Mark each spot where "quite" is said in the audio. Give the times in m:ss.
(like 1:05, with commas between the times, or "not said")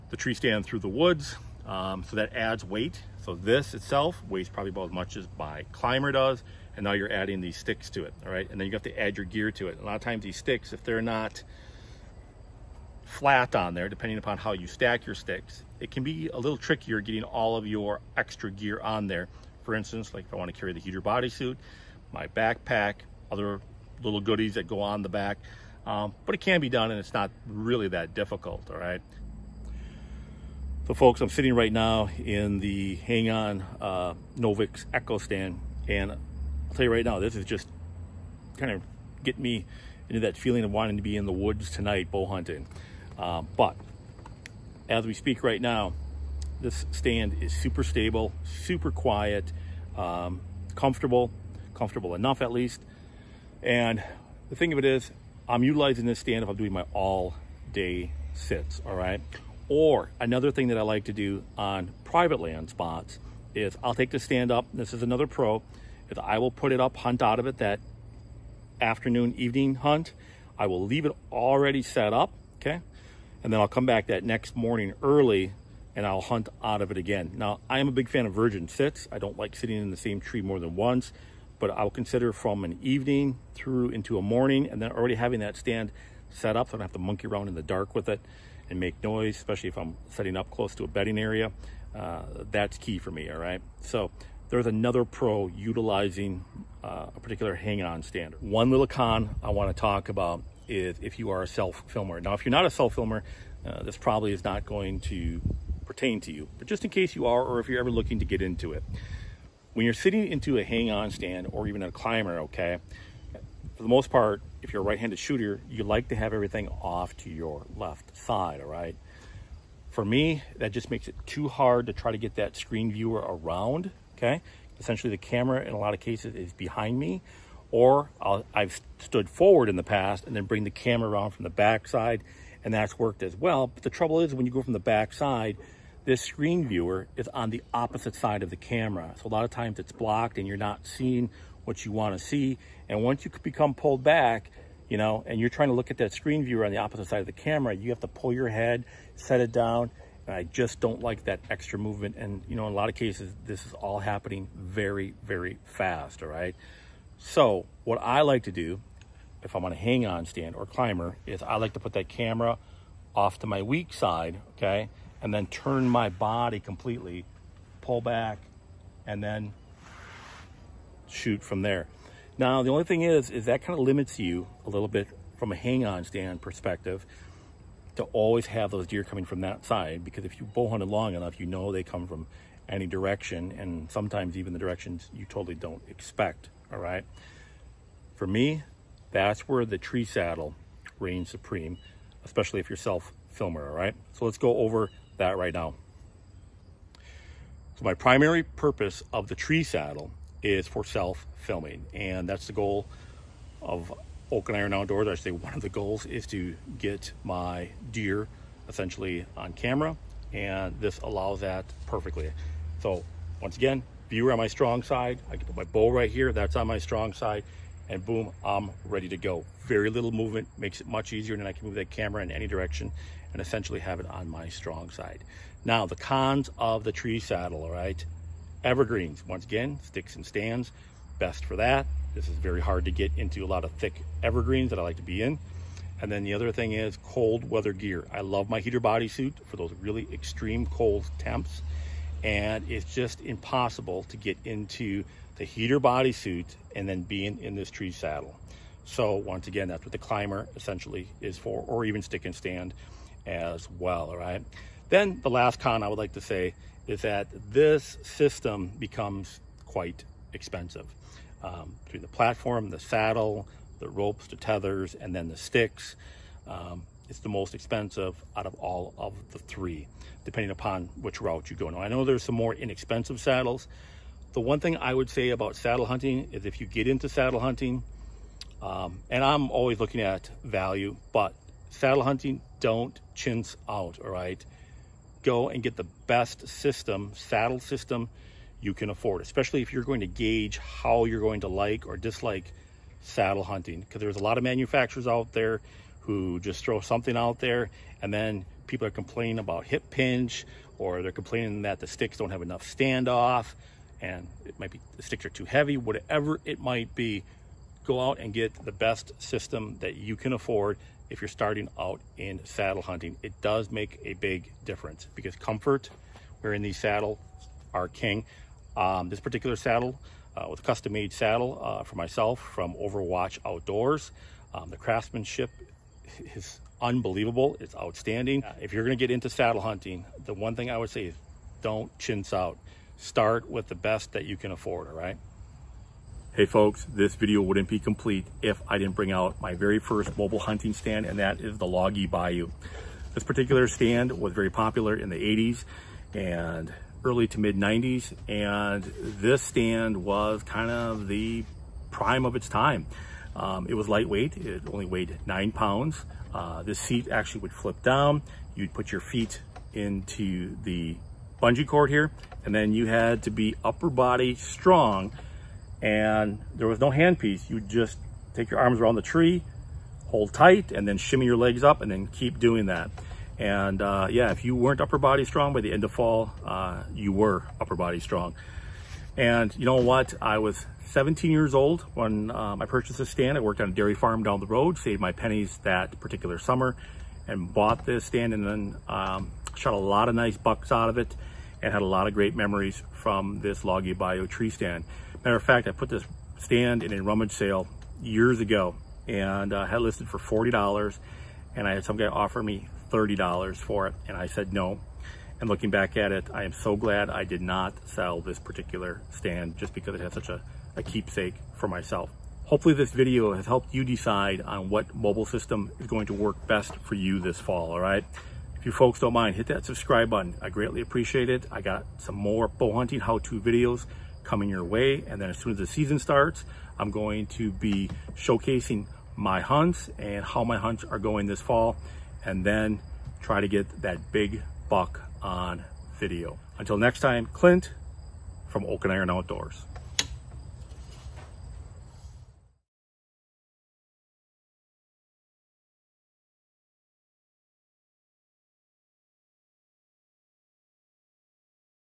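4:19.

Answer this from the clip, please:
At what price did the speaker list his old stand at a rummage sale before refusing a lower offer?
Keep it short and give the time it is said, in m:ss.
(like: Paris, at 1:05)
$40, at 6:40.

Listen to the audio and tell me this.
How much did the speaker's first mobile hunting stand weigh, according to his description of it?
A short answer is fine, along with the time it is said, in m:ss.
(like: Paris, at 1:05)
9 pounds, at 5:55.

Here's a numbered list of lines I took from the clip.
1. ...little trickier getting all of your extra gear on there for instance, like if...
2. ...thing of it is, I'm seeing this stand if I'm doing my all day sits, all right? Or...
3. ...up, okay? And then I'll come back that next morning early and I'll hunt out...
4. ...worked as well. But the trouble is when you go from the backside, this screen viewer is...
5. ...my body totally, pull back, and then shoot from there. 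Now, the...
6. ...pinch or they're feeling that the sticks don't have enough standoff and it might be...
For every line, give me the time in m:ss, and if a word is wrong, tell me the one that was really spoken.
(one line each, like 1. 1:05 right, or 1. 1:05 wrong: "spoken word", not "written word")
1. 0:16 right
2. 0:54 wrong: "utilizing", not "seeing"
3. 1:12 right
4. 2:12 right
5. 2:45 wrong: "completely", not "totally"
6. 4:59 wrong: "complaining", not "feeling".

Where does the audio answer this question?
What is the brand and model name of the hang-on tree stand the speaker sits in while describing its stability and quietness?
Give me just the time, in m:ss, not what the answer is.
0:34.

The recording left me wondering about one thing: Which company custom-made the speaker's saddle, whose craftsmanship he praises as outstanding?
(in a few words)
Overwatch Outdoors.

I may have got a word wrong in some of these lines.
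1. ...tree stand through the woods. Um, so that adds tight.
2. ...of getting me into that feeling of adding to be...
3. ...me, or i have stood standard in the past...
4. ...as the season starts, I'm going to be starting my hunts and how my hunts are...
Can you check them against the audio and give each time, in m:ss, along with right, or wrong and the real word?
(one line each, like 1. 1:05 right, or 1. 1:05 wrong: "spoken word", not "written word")
1. 0:00 wrong: "weight", not "tight"
2. 0:38 wrong: "wanting", not "adding"
3. 2:06 wrong: "forward", not "standard"
4. 7:05 wrong: "showcasing", not "starting".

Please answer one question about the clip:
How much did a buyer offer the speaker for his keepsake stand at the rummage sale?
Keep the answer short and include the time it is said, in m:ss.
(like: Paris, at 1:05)
$30, at 6:42.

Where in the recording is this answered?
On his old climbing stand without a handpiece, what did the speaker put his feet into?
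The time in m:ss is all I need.
6:01.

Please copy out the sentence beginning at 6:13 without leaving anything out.
And uh, yeah, if you weren't upper body strong by the end of fall, uh, you were upper body strong.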